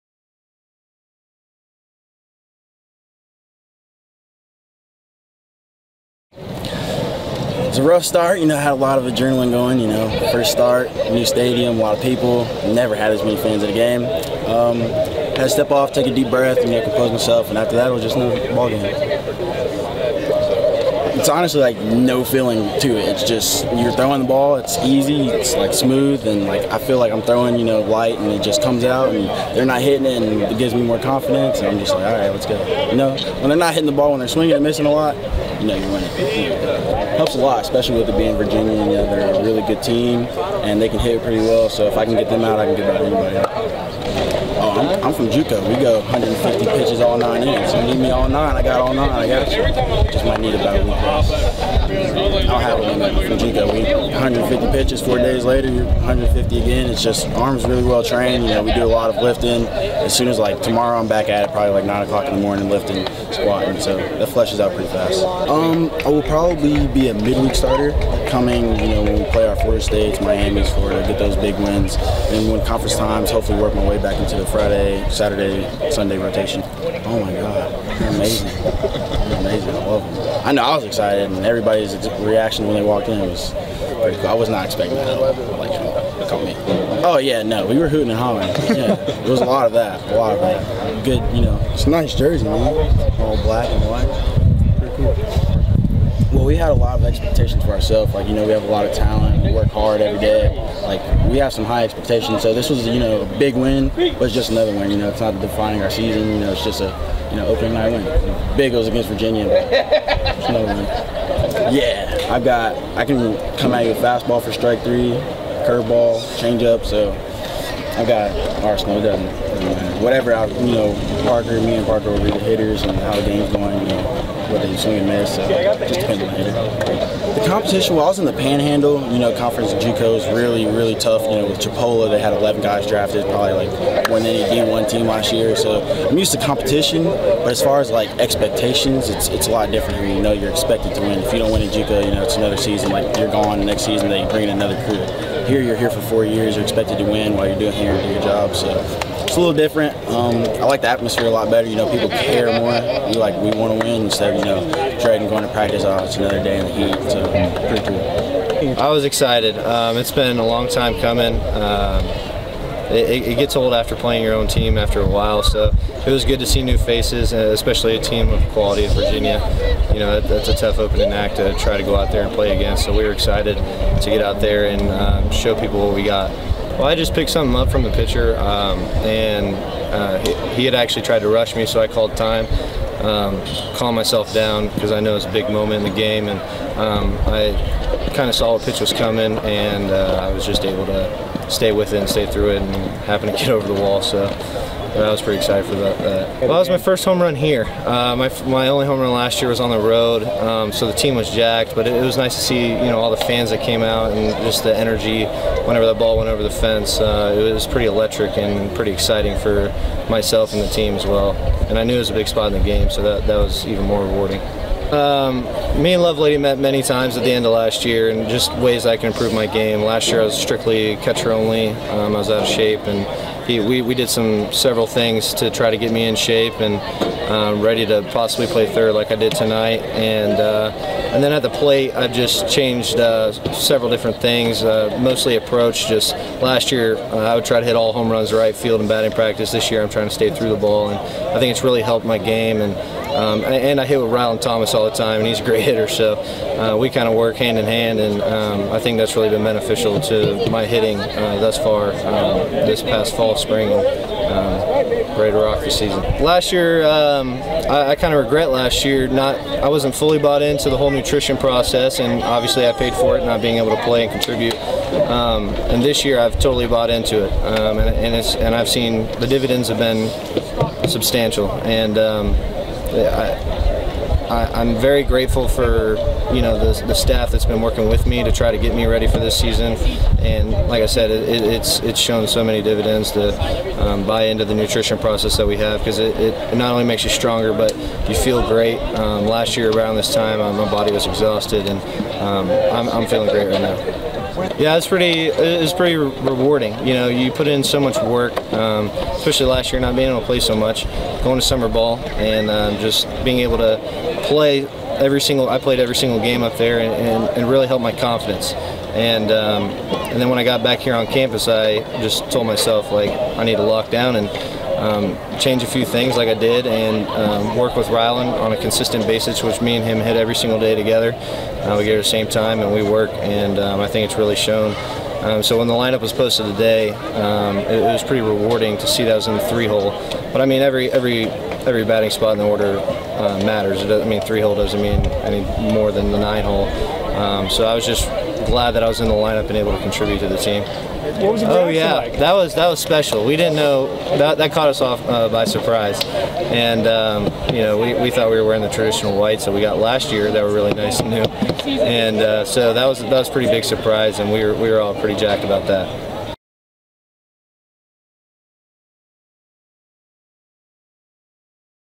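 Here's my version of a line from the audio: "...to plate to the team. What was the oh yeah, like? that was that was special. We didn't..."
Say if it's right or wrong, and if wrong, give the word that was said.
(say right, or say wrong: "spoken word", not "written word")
wrong: "contribute", not "plate".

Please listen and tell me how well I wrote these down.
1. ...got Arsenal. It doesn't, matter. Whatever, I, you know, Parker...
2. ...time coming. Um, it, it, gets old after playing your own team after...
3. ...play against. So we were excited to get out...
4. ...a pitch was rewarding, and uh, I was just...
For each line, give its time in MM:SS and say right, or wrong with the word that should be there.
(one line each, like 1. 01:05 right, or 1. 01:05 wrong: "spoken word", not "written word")
1. 01:58 right
2. 02:40 right
3. 02:52 right
4. 03:08 wrong: "coming", not "rewarding".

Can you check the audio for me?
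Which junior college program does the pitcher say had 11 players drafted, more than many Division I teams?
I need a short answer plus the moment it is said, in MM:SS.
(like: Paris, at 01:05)
Chipola, at 02:11.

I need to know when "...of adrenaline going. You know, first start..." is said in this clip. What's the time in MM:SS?
00:08.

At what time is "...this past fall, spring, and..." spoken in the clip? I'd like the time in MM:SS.
04:12.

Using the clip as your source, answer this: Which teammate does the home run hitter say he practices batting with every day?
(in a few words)
Rylan Thomas.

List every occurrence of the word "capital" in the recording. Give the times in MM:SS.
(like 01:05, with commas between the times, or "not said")
not said.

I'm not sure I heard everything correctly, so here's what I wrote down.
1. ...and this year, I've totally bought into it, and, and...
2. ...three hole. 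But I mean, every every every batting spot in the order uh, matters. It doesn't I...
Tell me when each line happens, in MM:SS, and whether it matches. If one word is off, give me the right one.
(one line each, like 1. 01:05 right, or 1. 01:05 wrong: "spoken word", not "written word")
1. 04:25 right
2. 05:29 right.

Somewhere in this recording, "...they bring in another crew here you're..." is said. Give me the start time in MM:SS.
02:24.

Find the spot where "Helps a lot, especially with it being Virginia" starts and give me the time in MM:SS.
00:37.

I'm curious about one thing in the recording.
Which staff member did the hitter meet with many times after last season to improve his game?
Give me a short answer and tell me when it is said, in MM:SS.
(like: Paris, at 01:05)
Lovelady, at 03:36.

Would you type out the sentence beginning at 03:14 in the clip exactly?
So but I was pretty excited for that.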